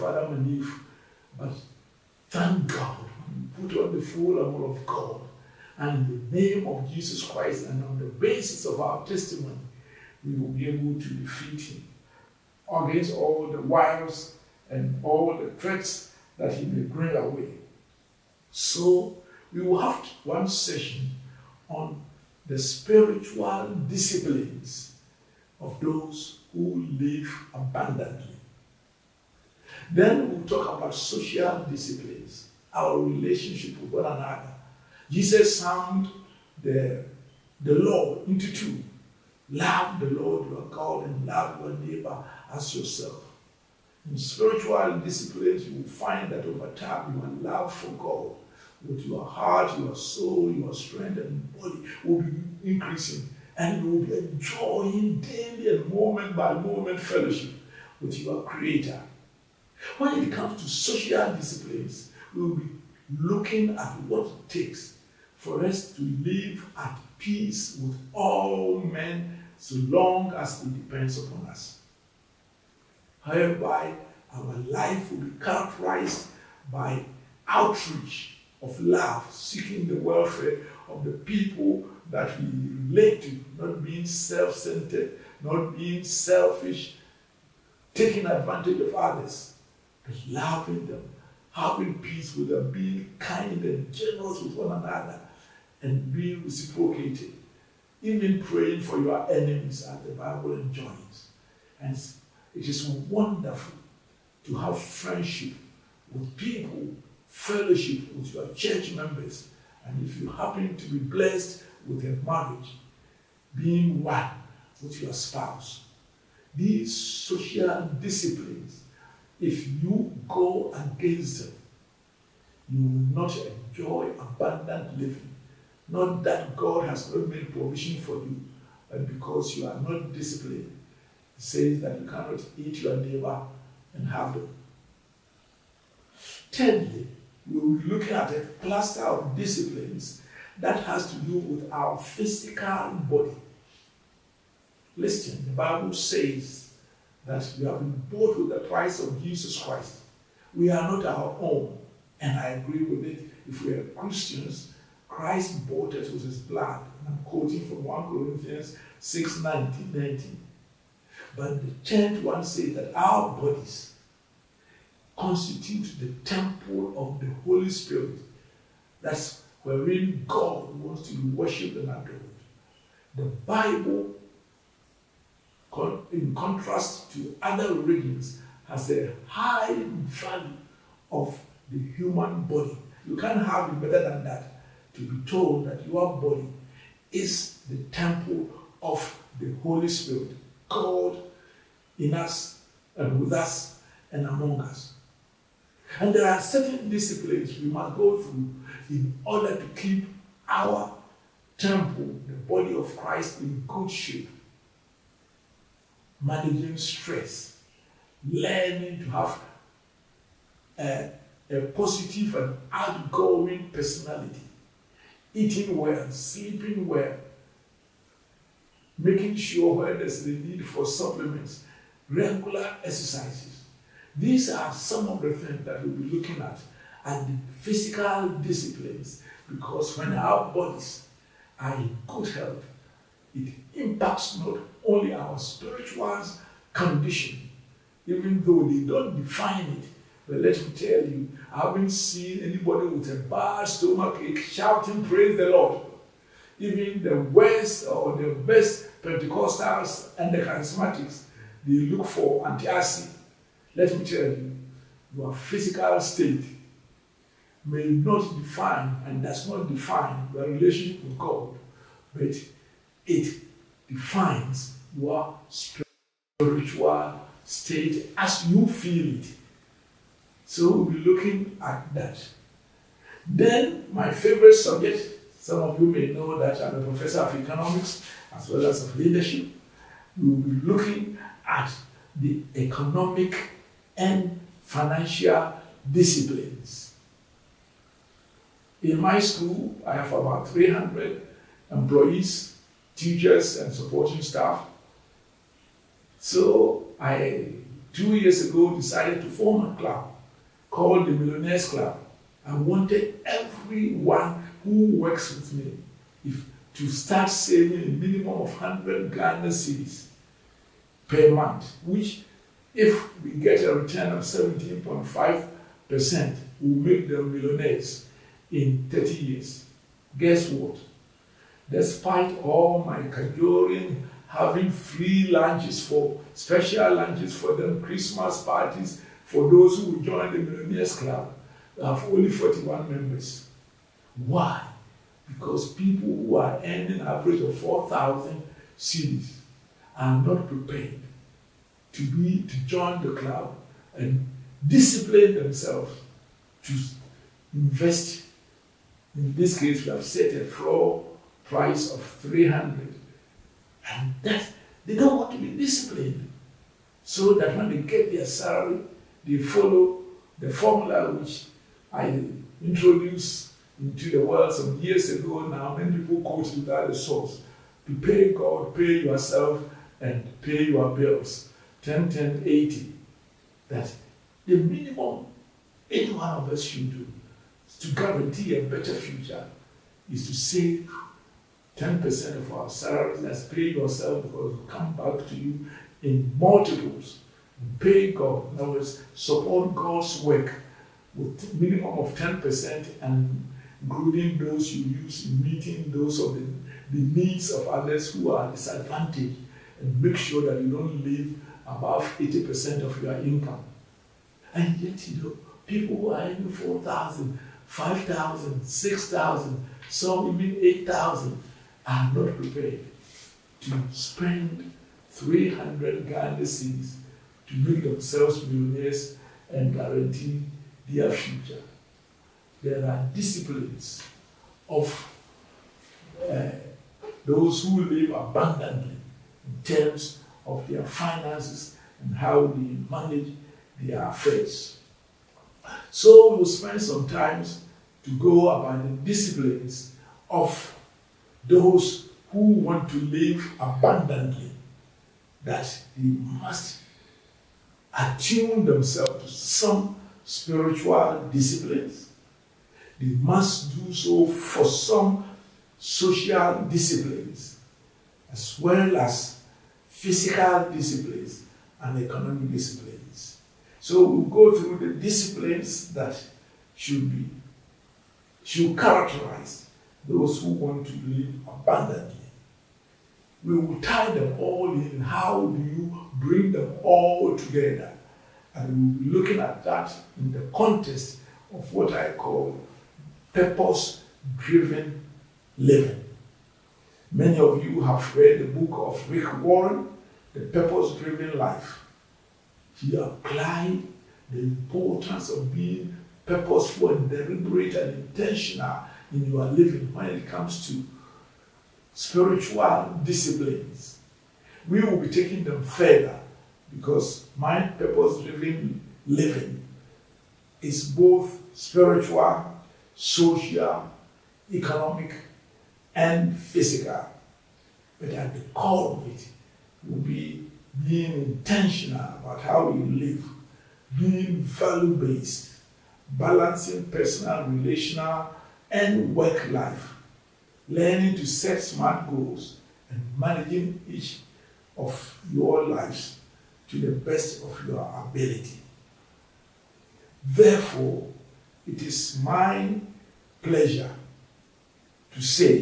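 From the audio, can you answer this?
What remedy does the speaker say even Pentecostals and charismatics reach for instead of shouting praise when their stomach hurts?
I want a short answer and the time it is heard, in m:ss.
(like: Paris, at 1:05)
Antacid, at 4:12.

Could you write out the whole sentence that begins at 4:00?
But let me tell you, I haven't seen anybody with a bad stomachache shouting, Praise the Lord.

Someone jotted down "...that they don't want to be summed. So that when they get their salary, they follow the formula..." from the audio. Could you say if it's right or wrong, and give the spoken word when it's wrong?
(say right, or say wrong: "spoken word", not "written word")
wrong: "disciplined", not "summed".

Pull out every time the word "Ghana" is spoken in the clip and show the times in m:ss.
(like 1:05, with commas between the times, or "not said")
5:09, 6:56.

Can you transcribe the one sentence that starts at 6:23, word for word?
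That's pay yourself because it will come back to you in multiples.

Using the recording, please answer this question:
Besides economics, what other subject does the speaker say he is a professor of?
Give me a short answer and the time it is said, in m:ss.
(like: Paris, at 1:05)
Leadership, at 4:38.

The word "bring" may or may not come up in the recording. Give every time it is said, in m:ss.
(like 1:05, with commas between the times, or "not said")
0:16, 7:56.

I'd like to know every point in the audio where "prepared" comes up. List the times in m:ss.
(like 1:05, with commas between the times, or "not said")
5:40, 6:52.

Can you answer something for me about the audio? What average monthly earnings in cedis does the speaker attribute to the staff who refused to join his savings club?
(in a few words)
4,000 cedis.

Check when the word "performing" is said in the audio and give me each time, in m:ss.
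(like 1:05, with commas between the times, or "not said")
not said.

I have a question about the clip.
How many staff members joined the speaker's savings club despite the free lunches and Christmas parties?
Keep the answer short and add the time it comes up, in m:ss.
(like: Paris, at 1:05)
41, at 5:32.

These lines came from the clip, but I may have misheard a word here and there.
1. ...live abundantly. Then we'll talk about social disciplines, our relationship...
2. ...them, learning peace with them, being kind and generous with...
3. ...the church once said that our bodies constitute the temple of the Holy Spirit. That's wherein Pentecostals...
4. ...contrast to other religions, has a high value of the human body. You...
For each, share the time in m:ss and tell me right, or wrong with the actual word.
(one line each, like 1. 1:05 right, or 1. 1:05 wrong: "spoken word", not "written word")
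1. 0:26 right
2. 1:30 wrong: "having", not "learning"
3. 2:41 wrong: "God", not "Pentecostals"
4. 2:56 right.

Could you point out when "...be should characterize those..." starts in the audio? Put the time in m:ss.
7:47.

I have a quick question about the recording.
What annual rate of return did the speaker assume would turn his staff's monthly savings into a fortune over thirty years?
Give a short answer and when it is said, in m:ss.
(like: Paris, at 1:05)
17.5%, at 5:14.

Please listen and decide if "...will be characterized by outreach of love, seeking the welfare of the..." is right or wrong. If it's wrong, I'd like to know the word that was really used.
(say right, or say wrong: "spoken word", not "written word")
right.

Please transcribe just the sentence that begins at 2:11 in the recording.
It says that you cannot eat your neighbor and have them.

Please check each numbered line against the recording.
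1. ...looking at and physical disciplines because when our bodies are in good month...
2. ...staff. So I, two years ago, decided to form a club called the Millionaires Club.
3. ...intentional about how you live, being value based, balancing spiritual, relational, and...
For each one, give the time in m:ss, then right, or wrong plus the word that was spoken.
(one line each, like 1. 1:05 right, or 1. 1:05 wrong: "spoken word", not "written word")
1. 3:46 wrong: "health", not "month"
2. 4:54 right
3. 8:41 wrong: "personal", not "spiritual".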